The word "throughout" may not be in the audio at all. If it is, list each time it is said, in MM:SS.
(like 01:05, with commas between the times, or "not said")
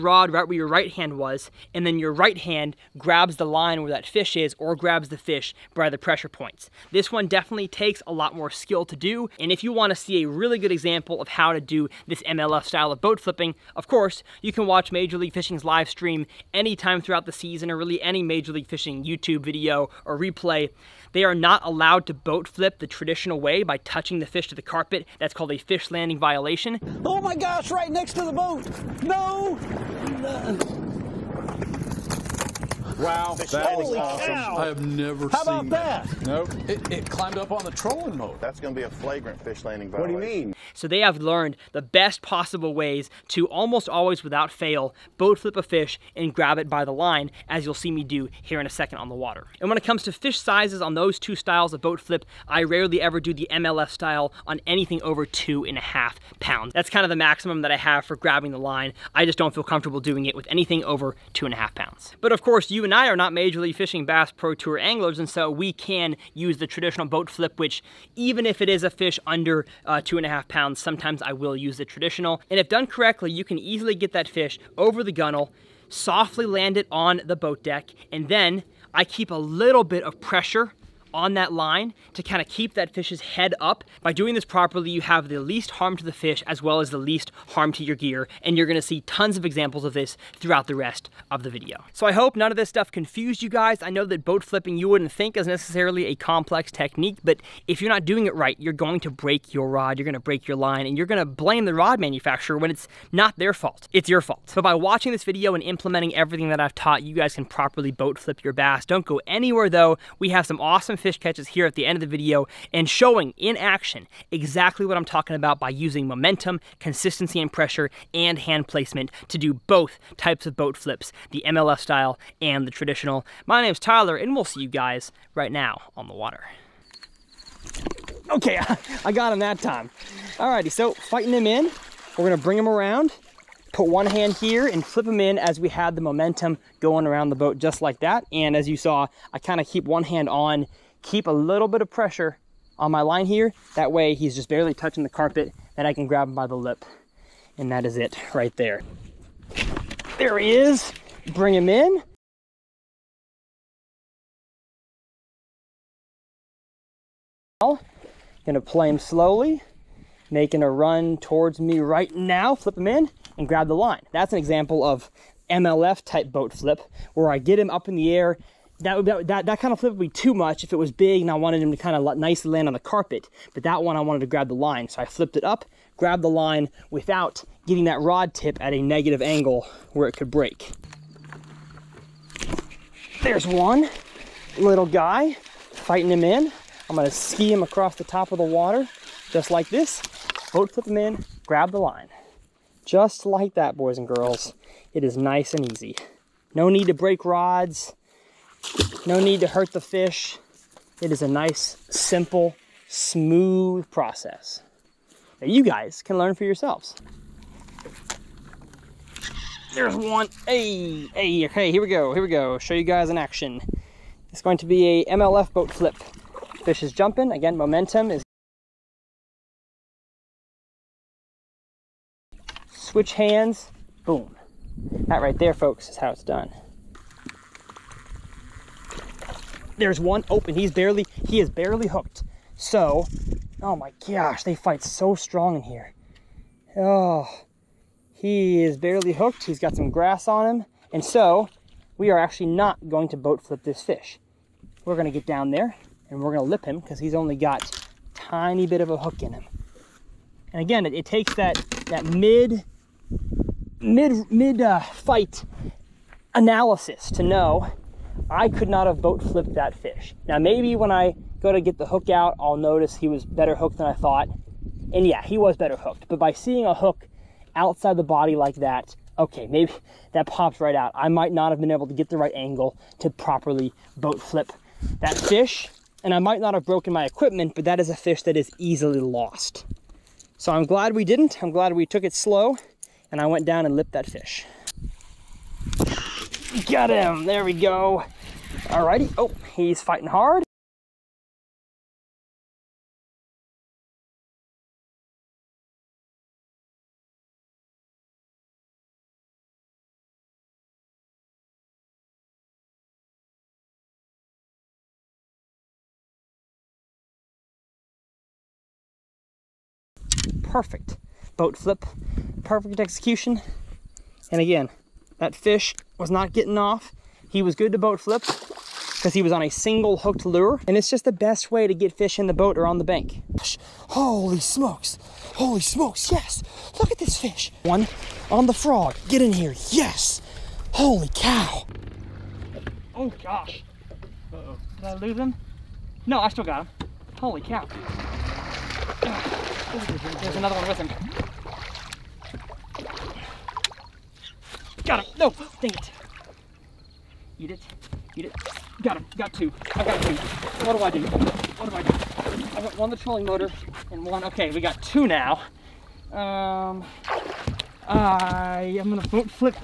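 00:17, 01:30.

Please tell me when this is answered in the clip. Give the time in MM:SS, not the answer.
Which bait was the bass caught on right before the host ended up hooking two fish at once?
05:28.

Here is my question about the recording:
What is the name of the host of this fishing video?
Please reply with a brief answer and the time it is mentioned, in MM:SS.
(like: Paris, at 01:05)
Tyler, at 02:03.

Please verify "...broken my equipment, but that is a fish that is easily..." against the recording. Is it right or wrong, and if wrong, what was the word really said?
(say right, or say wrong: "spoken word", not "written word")
right.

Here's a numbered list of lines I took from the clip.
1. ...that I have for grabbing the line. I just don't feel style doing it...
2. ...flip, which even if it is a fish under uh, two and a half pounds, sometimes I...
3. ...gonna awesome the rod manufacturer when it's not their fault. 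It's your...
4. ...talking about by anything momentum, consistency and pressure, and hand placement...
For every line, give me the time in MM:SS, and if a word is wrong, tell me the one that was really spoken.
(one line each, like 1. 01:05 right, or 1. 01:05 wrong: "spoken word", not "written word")
1. 00:57 wrong: "comfortable", not "style"
2. 01:07 right
3. 01:41 wrong: "blame", not "awesome"
4. 01:55 wrong: "using", not "anything".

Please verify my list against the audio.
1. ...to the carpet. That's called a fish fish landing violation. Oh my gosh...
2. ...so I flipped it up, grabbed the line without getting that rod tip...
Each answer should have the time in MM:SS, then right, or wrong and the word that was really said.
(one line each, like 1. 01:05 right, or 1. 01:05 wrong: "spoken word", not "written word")
1. 00:24 right
2. 02:54 right.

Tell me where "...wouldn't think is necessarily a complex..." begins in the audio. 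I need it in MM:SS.
01:34.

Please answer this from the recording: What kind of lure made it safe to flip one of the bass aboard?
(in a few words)
single hooked lure.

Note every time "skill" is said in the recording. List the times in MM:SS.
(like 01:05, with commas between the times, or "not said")
00:08.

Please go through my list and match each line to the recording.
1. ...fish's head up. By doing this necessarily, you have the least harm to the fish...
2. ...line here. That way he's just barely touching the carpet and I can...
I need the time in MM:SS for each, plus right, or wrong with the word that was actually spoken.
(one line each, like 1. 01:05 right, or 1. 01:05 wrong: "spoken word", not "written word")
1. 01:22 wrong: "properly", not "necessarily"
2. 02:23 right.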